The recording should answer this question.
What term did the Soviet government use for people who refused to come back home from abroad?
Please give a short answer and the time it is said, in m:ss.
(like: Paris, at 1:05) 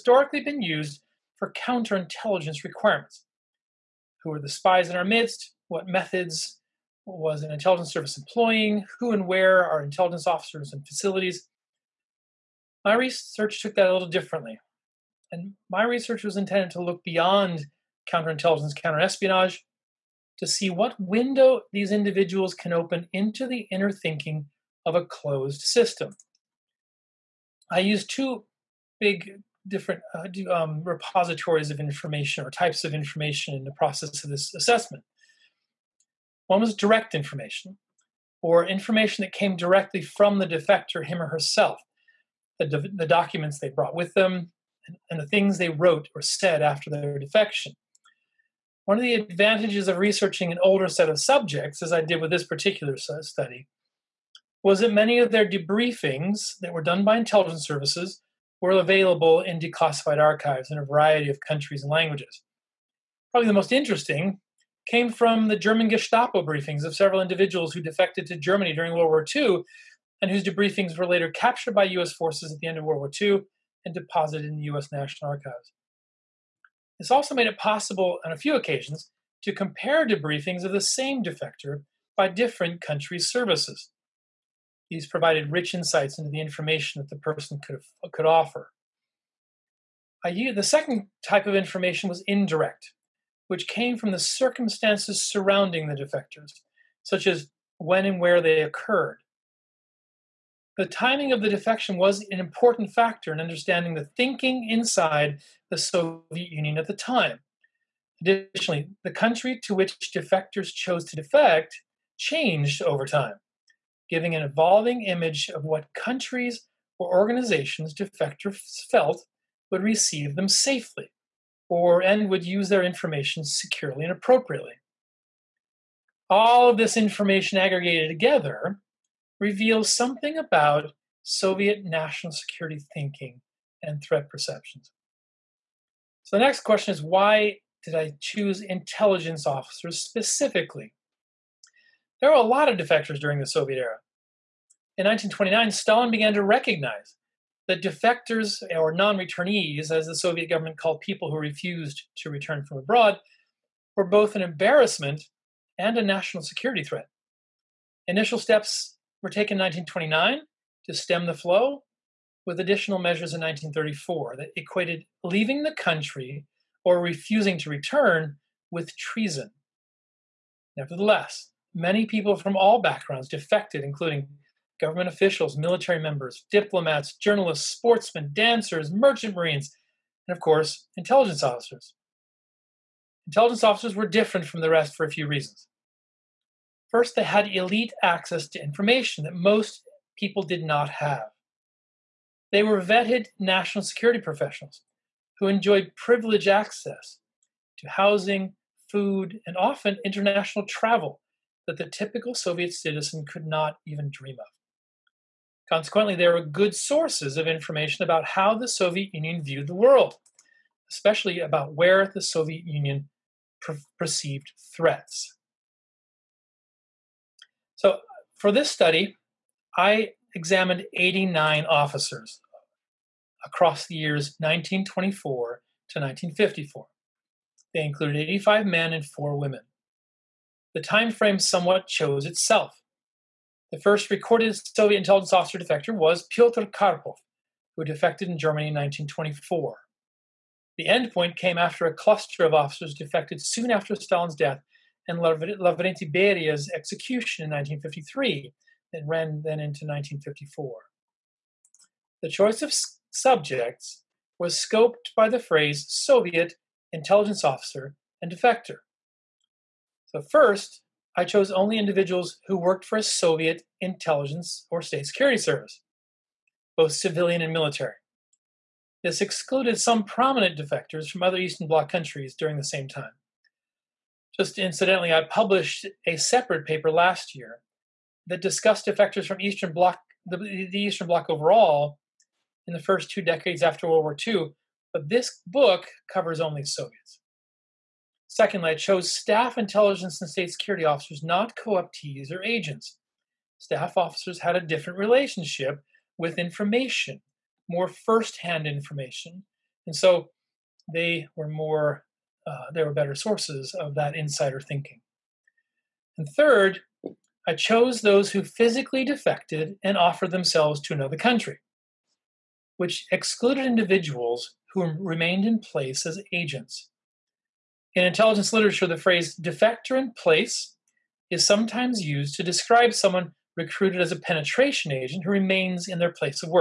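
non-returnees, at 2:28.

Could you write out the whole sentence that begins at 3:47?
They included 85 men and 4 women.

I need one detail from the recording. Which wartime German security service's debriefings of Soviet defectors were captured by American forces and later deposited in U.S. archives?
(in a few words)
Gestapo.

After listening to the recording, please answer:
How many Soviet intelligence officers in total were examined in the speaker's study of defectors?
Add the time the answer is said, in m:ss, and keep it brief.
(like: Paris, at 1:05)
89, at 3:40.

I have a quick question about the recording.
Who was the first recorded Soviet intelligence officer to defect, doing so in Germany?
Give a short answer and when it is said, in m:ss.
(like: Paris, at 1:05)
Pyotr Karpov, at 3:56.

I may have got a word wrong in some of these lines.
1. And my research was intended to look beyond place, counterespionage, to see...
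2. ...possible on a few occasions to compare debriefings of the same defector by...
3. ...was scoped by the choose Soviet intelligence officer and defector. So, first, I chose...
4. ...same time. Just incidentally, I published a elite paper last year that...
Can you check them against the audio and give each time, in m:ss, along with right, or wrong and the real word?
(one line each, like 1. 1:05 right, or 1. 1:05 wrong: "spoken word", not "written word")
1. 0:15 wrong: "counterintelligence", not "place"
2. 1:17 right
3. 4:14 wrong: "phrase", not "choose"
4. 4:32 wrong: "separate", not "elite".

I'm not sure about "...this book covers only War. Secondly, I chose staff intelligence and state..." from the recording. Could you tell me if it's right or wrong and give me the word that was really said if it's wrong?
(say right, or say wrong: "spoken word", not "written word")
wrong: "Soviets", not "War".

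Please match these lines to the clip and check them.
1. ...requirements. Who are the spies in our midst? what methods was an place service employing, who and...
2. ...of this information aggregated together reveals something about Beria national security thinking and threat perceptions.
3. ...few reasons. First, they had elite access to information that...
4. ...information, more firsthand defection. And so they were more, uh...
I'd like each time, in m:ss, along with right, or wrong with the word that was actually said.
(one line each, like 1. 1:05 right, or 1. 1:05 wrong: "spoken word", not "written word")
1. 0:02 wrong: "intelligence", not "place"
2. 2:06 wrong: "Soviet", not "Beria"
3. 3:05 right
4. 4:56 wrong: "information", not "defection".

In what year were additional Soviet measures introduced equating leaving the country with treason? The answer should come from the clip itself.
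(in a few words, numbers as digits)
1934.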